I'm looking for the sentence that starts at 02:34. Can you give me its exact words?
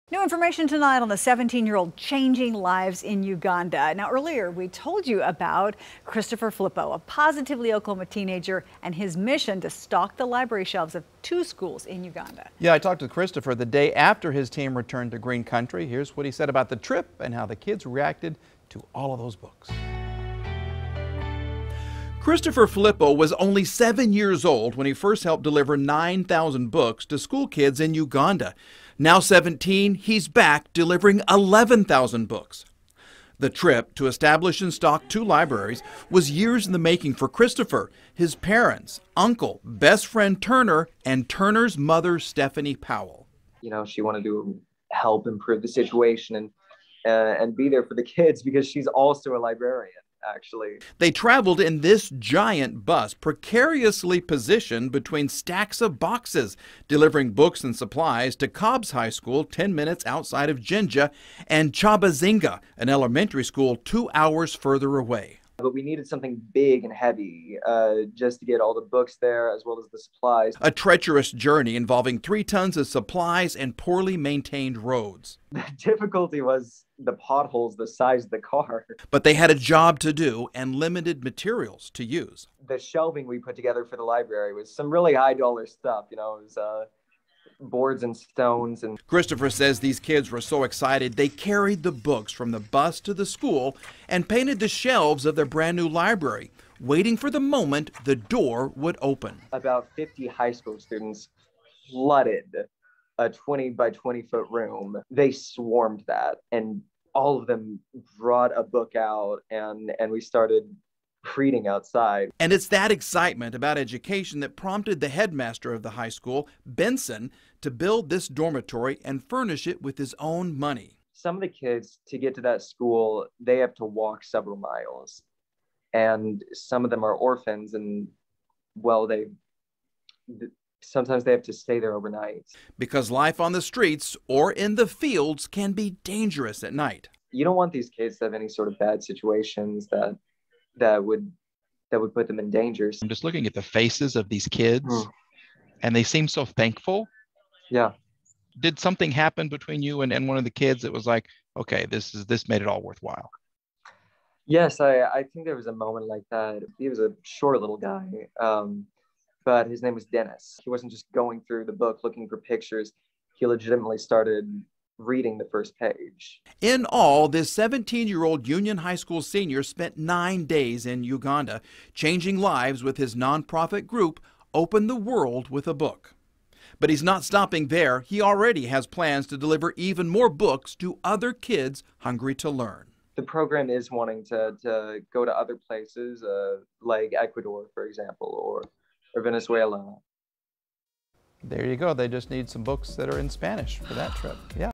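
Yes, I, I think there was a moment like that.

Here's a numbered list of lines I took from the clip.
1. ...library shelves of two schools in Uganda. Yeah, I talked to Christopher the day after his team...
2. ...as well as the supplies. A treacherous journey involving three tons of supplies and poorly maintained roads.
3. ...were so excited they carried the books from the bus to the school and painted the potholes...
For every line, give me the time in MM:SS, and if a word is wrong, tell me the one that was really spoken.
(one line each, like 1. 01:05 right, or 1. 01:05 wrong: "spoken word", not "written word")
1. 00:10 right
2. 01:09 right
3. 01:30 wrong: "shelves", not "potholes".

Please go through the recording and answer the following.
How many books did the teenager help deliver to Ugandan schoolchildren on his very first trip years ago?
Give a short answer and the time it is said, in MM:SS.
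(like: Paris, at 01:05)
9,000, at 00:25.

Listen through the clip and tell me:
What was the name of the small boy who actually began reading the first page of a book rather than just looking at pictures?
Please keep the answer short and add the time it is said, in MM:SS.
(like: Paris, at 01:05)
Dennis, at 02:40.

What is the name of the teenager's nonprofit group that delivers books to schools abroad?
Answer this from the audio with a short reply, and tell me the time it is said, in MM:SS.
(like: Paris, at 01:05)
Open the World with a Book, at 02:54.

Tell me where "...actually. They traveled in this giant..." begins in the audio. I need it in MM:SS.
00:50.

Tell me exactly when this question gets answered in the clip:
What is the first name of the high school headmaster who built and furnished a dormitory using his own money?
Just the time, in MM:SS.
01:56.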